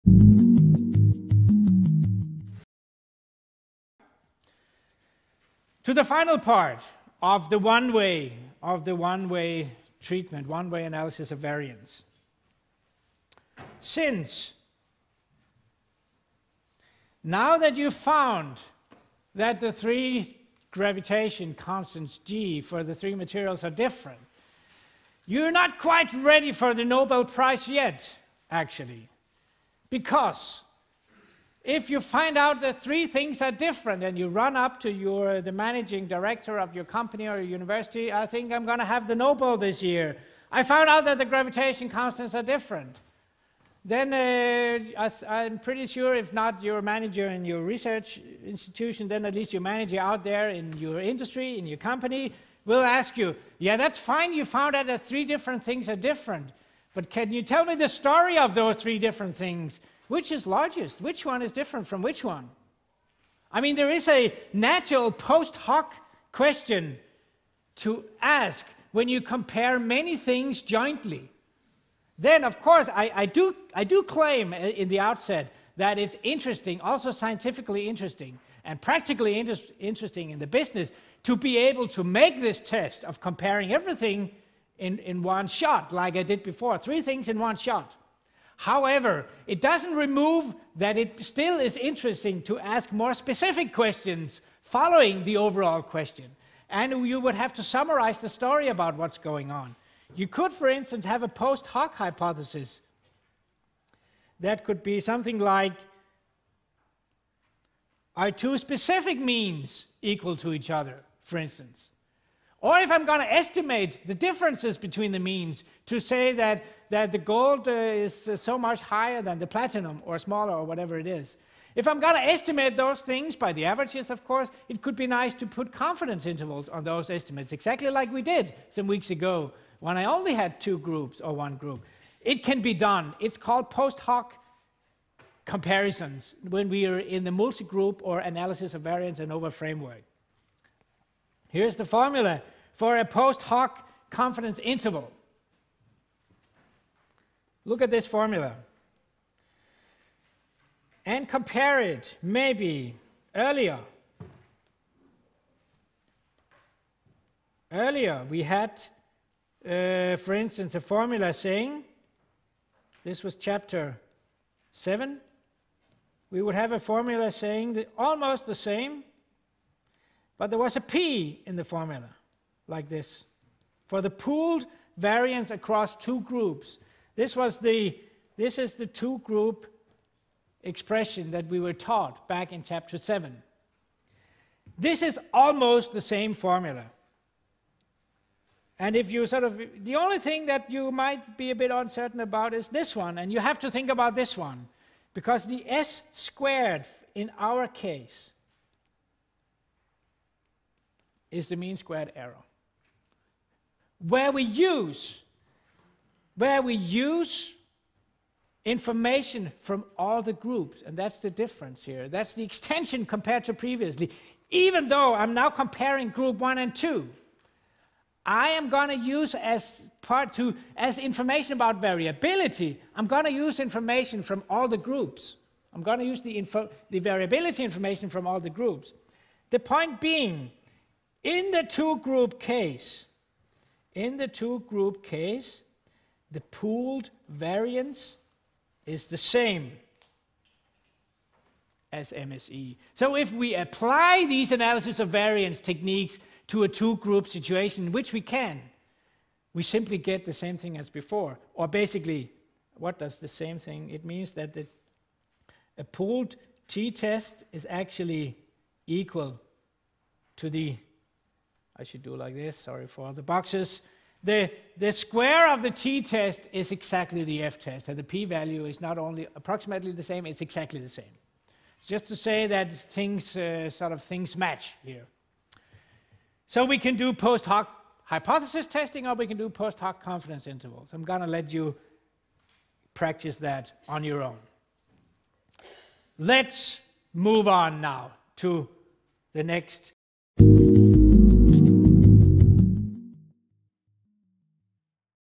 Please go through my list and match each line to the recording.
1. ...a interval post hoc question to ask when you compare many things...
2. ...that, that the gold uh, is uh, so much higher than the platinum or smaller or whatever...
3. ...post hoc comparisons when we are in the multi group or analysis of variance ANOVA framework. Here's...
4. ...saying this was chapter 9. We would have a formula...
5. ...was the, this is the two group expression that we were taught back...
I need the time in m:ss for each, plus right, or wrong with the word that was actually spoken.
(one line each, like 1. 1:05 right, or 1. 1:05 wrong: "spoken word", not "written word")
1. 1:04 wrong: "natural", not "interval"
2. 1:56 right
3. 2:13 right
4. 2:41 wrong: "7", not "9"
5. 2:57 right.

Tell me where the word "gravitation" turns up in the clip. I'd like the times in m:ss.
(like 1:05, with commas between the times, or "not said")
0:20, 0:41.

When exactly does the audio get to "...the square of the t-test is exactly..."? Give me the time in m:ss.
4:24.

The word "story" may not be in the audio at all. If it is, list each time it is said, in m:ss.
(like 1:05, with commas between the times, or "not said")
0:57, 1:38.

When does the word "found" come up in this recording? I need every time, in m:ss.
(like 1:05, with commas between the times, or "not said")
0:17, 0:40, 0:54.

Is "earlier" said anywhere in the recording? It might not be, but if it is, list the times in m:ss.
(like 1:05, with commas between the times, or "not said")
2:33, 2:37.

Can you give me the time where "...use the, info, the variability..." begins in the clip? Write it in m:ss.
3:46.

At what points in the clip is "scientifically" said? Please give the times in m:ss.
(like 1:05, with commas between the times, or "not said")
1:17.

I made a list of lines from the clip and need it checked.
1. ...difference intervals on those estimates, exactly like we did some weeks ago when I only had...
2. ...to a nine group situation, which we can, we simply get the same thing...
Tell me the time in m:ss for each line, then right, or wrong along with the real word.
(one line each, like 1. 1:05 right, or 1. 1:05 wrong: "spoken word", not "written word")
1. 2:05 wrong: "confidence", not "difference"
2. 4:06 wrong: "two", not "nine".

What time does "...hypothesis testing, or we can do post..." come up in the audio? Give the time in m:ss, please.
4:38.